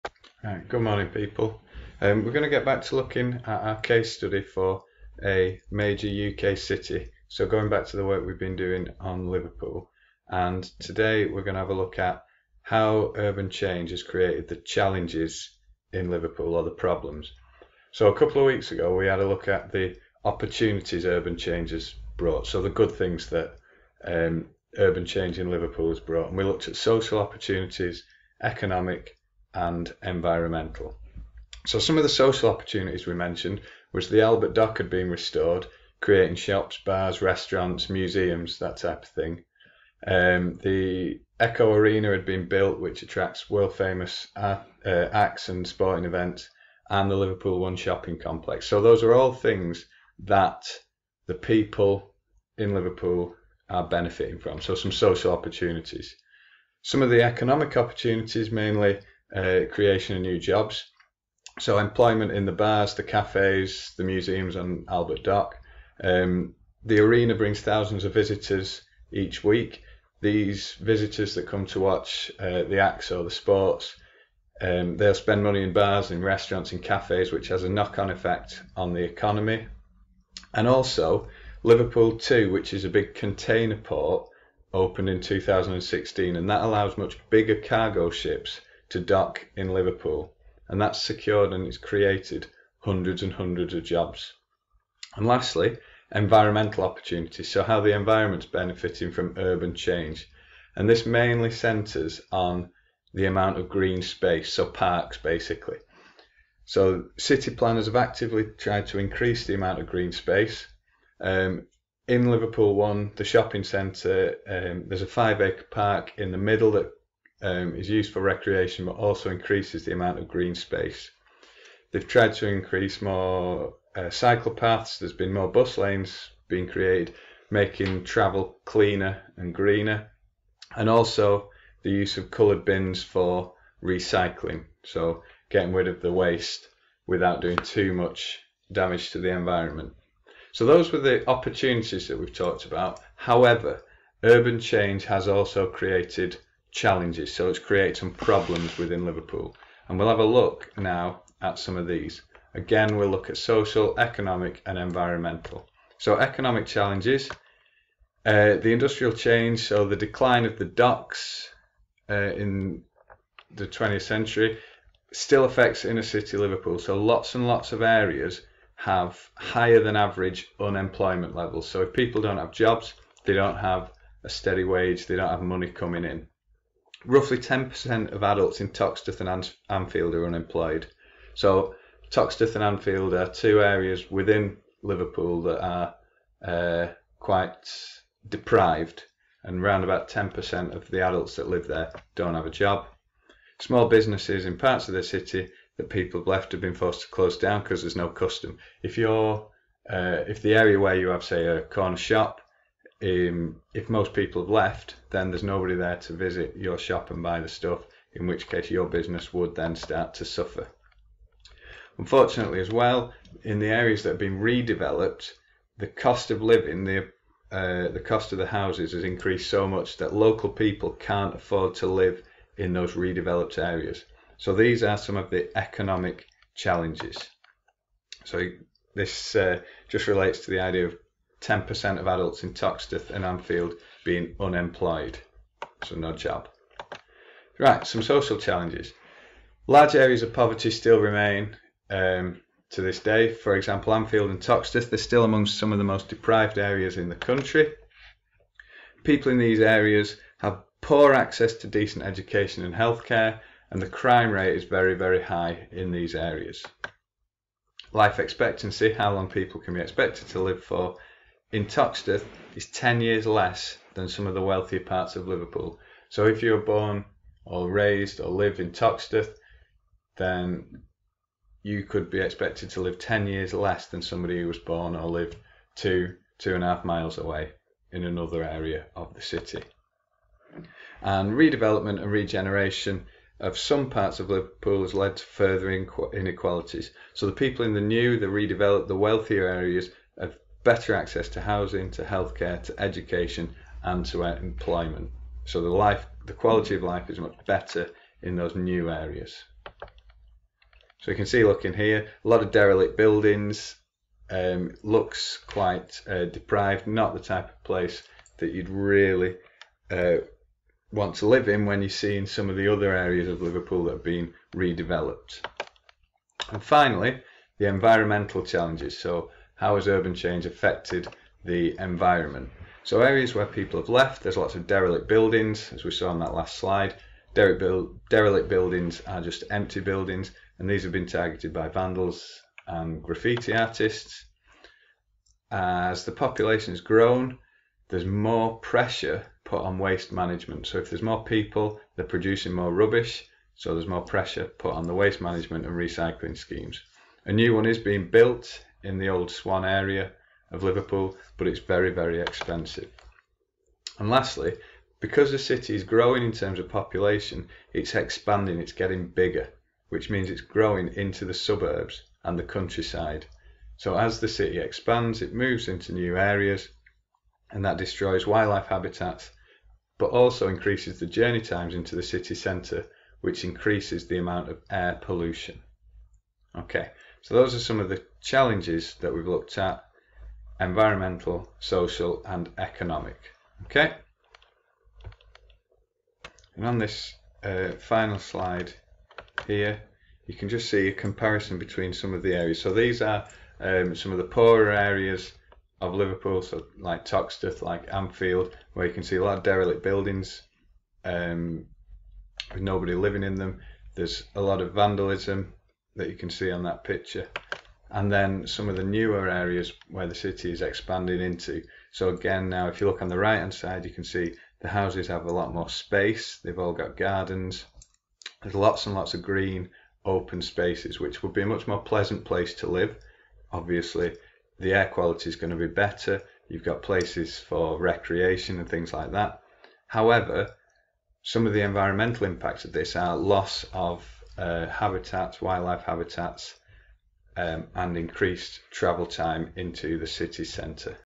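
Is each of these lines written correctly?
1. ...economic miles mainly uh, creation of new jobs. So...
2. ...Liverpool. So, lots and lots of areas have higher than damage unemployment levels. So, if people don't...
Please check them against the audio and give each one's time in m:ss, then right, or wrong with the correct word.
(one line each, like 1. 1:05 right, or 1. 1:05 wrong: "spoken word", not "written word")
1. 0:57 wrong: "opportunities", not "miles"
2. 2:46 wrong: "average", not "damage".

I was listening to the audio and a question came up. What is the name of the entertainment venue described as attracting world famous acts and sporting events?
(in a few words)
Echo Arena.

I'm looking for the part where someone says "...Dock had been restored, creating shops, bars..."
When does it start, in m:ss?
0:34.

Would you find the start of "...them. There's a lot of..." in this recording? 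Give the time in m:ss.
6:43.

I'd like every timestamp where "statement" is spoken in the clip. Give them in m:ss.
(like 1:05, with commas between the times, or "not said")
not said.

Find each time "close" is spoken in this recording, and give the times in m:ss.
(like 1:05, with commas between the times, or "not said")
3:17.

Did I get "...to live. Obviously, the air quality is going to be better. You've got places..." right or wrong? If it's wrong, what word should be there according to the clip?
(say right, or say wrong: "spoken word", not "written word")
right.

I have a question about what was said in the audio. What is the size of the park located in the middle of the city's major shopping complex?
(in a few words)
five acre.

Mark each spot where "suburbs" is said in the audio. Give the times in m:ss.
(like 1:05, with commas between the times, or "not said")
6:01.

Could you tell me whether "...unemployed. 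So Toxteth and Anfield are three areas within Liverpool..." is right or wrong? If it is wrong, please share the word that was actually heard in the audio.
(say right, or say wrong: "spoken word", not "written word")
wrong: "two", not "three".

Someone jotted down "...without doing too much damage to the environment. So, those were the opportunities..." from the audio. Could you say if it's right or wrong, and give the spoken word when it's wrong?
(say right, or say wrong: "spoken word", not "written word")
right.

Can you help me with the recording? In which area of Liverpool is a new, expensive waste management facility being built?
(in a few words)
Old Swan.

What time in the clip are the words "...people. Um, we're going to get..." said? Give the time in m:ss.
0:01.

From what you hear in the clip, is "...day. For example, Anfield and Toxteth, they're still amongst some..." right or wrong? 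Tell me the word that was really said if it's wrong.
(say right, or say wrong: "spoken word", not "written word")
right.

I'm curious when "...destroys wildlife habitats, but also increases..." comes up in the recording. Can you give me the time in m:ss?
6:07.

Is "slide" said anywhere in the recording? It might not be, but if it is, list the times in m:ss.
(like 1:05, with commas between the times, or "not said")
5:26, 6:28.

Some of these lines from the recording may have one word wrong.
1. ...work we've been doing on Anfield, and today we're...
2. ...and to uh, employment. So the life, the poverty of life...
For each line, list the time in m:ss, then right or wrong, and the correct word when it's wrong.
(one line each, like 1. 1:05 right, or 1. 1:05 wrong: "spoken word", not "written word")
1. 0:08 wrong: "Liverpool", not "Anfield"
2. 4:53 wrong: "quality", not "poverty".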